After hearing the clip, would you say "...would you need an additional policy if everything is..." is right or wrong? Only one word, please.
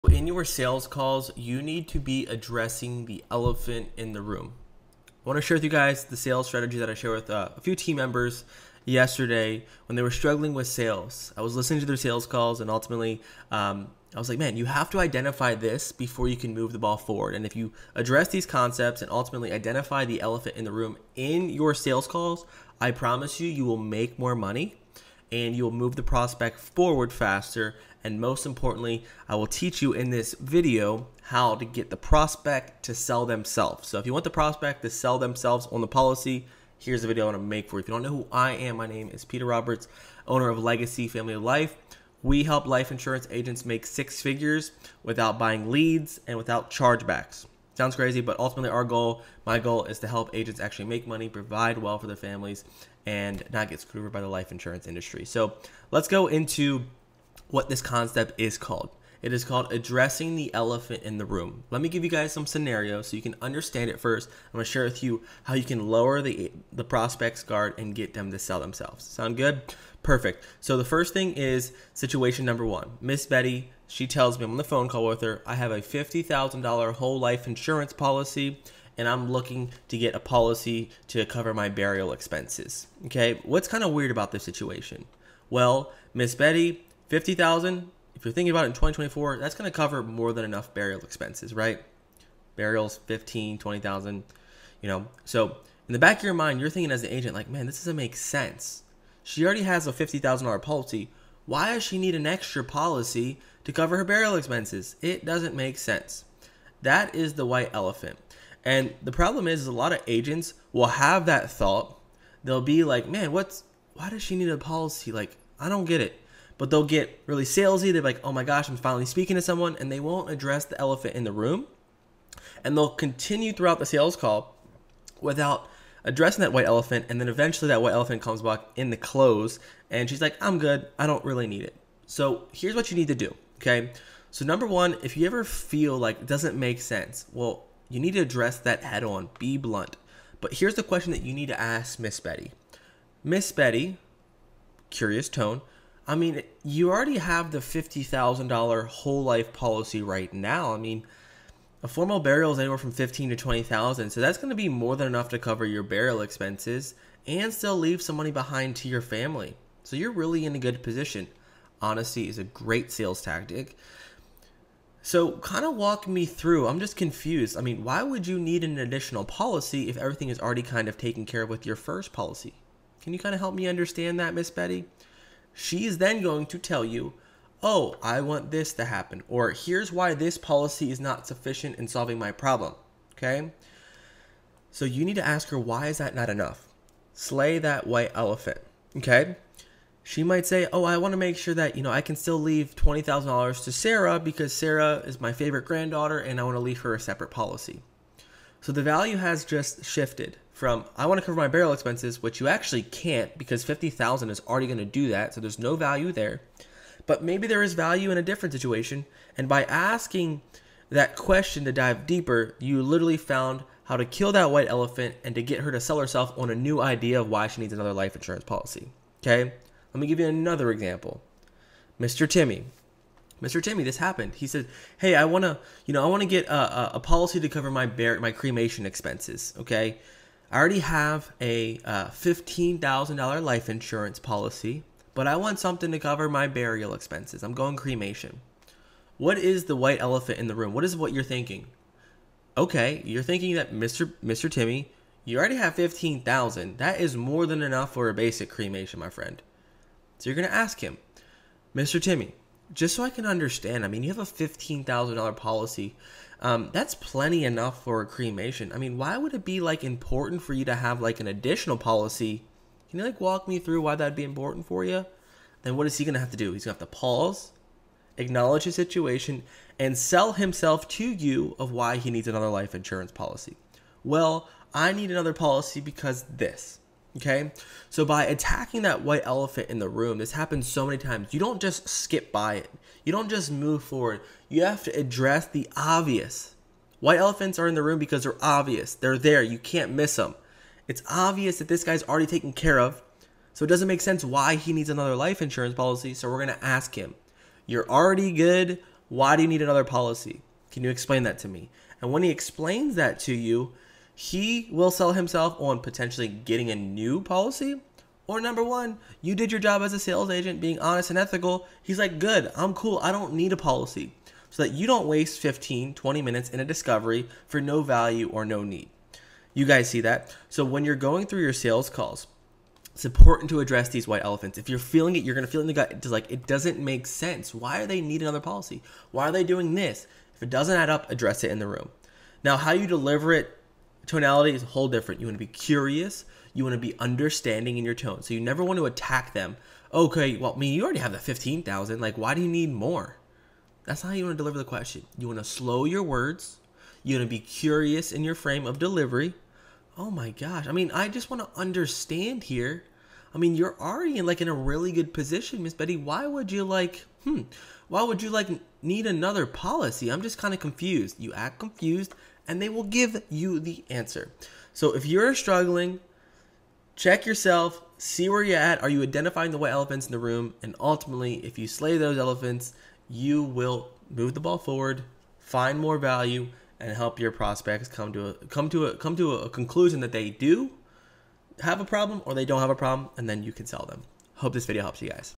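right.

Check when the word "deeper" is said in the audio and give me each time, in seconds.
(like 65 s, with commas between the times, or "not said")
212 s.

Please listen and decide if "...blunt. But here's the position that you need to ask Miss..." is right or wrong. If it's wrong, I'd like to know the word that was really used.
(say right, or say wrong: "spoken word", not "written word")
wrong: "question", not "position".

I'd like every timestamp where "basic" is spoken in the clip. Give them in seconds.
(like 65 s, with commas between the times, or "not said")
248 s.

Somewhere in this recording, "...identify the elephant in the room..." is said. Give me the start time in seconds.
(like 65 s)
19 s.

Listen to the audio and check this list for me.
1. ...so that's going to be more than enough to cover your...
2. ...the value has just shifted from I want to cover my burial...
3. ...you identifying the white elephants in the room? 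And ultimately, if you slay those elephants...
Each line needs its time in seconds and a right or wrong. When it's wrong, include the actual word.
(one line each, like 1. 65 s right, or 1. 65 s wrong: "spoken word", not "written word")
1. 154 s right
2. 198 s right
3. 368 s right.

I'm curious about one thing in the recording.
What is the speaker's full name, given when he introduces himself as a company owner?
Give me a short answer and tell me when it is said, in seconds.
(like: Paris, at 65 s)
Peter Roberts, at 39 s.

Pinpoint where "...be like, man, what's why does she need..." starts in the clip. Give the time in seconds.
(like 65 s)
112 s.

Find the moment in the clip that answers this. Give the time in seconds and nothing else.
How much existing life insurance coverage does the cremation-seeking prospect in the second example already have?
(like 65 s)
232 s.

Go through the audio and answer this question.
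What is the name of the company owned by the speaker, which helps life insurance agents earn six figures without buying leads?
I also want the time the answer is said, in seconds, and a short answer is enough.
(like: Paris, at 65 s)
Legacy Family Life, at 40 s.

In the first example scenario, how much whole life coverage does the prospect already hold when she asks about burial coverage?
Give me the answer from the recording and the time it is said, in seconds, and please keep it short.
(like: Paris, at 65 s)
$50,000, at 75 s.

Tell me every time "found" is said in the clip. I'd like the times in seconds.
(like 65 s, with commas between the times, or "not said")
213 s.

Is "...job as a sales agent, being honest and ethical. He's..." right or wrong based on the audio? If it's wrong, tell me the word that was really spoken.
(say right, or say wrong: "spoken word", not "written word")
right.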